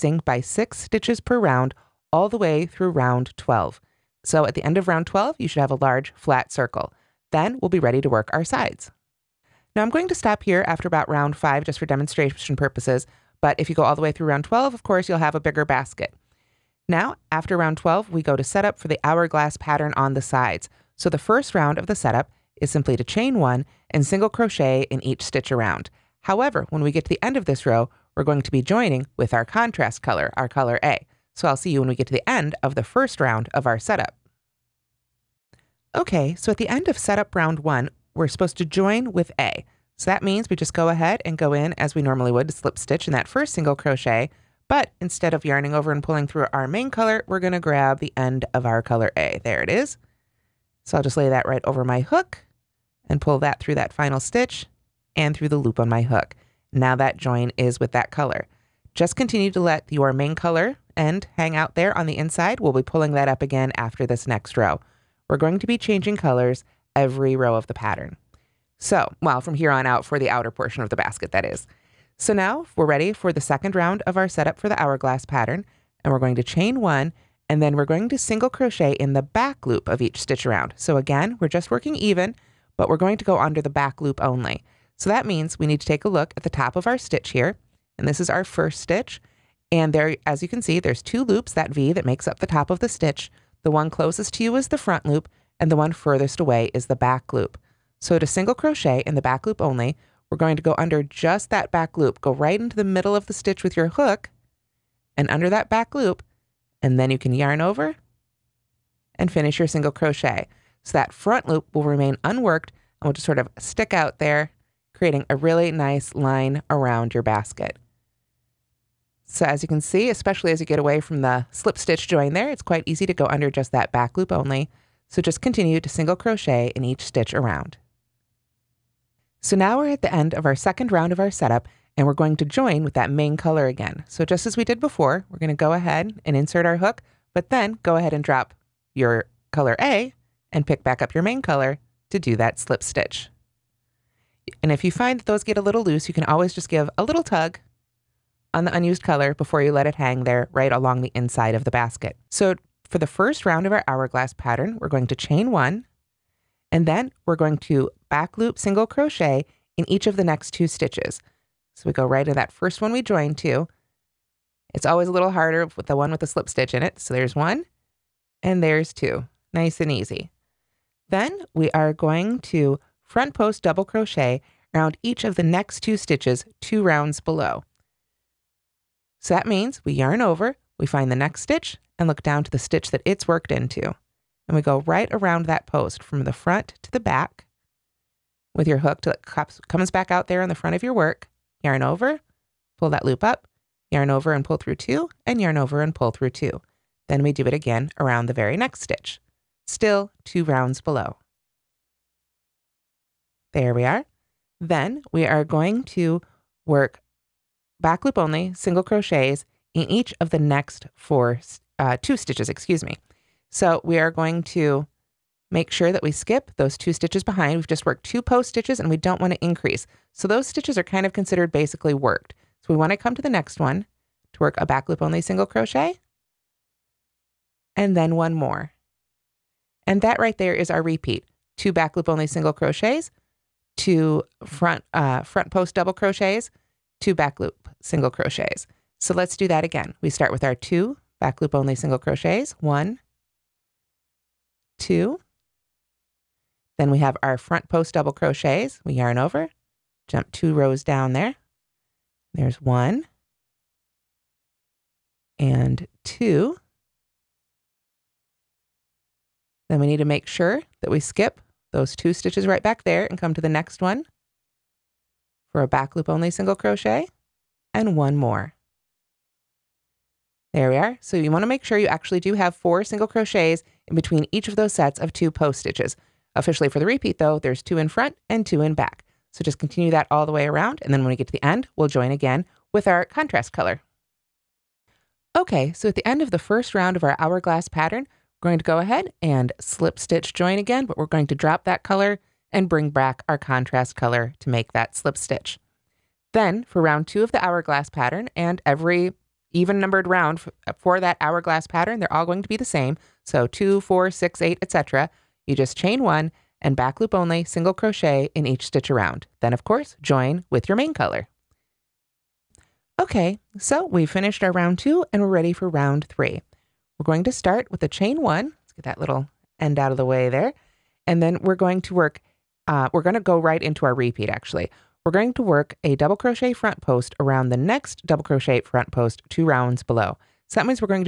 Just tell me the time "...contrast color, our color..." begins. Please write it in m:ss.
0:29.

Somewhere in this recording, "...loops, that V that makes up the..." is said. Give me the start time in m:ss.
1:31.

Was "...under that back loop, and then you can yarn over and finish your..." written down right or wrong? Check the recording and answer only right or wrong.
right.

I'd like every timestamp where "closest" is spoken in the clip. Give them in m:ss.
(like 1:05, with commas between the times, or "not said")
1:33.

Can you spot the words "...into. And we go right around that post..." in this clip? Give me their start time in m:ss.
3:03.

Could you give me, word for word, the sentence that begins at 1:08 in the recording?
So, well, from here on out for the outer portion of the basket, that is.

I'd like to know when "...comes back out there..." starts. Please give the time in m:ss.
3:09.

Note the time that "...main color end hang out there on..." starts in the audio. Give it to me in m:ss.
1:00.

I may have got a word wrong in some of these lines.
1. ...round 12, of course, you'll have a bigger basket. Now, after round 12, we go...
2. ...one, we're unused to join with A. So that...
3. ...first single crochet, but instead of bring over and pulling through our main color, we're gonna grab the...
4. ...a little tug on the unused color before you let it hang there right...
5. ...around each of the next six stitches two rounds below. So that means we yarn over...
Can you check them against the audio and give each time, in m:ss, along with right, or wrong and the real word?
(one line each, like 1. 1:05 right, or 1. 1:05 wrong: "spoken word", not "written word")
1. 0:14 right
2. 0:37 wrong: "supposed", not "unused"
3. 0:43 wrong: "yarning", not "bring"
4. 2:26 right
5. 2:54 wrong: "two", not "six".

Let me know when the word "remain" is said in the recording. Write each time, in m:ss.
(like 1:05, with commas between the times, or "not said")
1:51.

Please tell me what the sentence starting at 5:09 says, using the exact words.
Then, of course, join with your main color.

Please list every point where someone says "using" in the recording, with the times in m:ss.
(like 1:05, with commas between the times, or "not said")
not said.